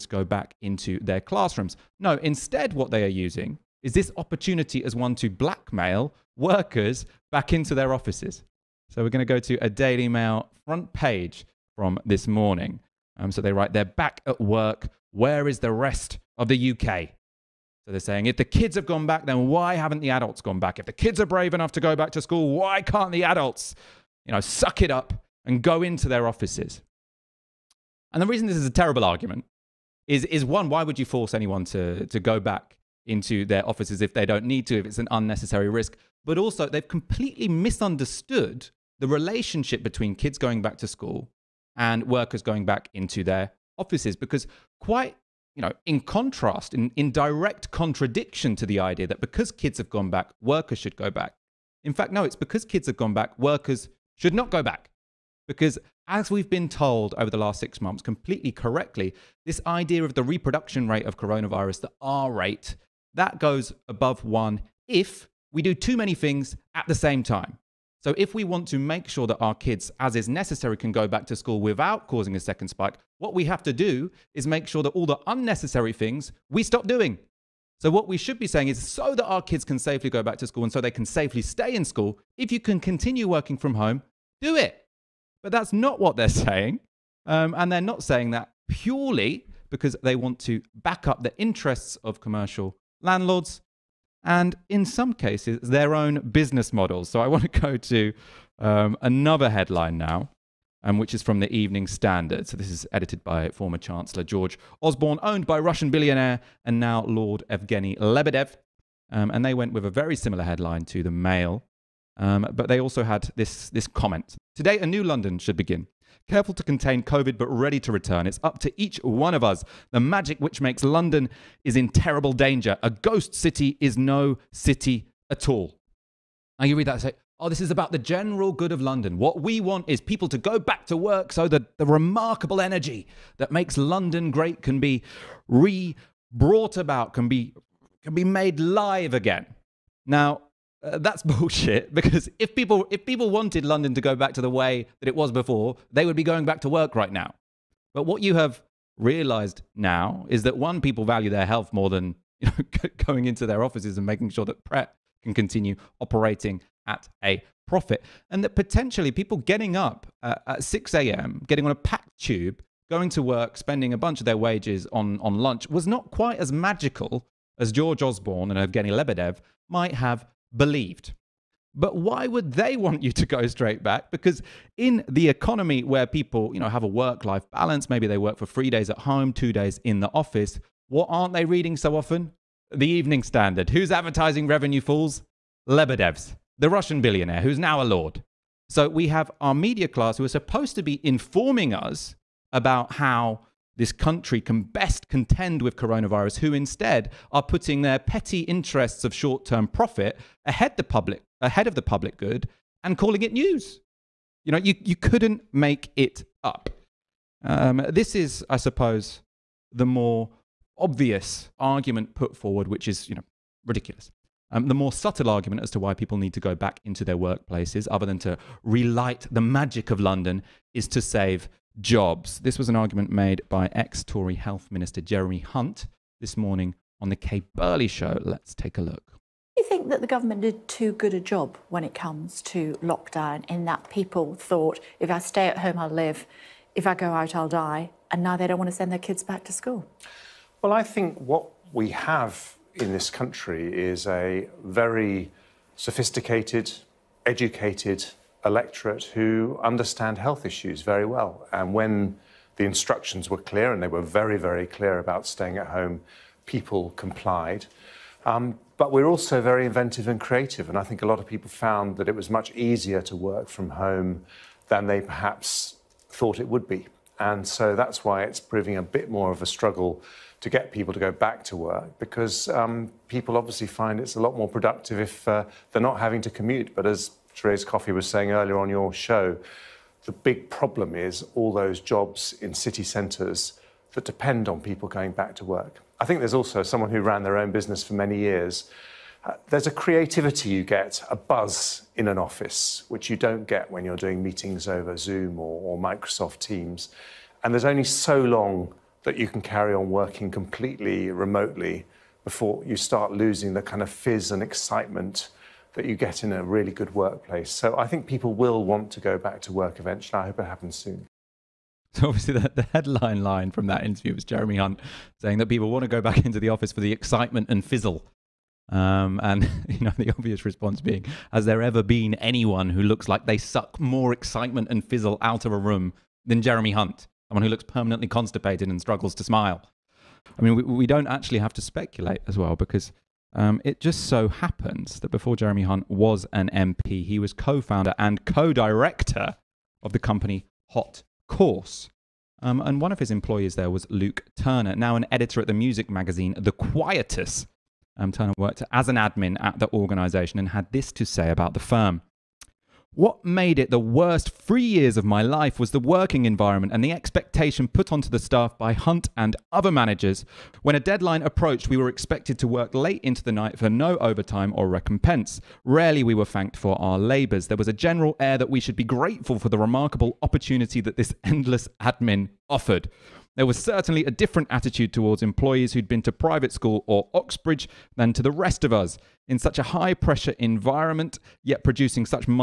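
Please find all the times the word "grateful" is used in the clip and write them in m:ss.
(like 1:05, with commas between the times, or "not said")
6:08.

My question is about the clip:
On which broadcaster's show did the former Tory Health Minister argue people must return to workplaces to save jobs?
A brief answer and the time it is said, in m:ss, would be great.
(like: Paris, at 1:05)
Kay Burley Show, at 3:47.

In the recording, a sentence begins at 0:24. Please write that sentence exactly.
you know, suck it up and go into their offices.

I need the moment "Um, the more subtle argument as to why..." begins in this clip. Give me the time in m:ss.
3:34.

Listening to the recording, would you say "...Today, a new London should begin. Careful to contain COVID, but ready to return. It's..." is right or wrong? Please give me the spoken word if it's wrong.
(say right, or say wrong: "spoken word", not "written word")
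right.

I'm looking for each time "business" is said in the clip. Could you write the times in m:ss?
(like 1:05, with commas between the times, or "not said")
1:36, 4:47.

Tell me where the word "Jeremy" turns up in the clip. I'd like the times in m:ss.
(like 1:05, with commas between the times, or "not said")
3:45, 5:14, 5:26, 5:35.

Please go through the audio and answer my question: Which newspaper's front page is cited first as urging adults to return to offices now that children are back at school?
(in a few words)
Daily Mail.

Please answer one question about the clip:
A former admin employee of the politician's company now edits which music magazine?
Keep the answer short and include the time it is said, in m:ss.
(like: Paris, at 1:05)
The Quietus, at 5:46.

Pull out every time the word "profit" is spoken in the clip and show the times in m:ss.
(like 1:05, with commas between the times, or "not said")
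2:37, 3:19.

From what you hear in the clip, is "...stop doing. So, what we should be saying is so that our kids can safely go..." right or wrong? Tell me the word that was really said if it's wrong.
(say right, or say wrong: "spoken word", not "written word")
right.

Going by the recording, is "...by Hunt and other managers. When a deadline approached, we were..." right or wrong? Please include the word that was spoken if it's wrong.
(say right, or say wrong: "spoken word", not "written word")
right.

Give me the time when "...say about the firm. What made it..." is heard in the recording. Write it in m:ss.
5:51.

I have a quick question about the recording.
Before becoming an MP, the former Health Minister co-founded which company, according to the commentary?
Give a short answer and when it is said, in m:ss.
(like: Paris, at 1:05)
Hot Course, at 5:40.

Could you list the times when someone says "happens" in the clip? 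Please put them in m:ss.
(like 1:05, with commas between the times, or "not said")
5:10, 5:34.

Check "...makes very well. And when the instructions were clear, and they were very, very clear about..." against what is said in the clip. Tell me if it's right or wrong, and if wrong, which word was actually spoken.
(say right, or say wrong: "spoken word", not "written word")
wrong: "issues", not "makes".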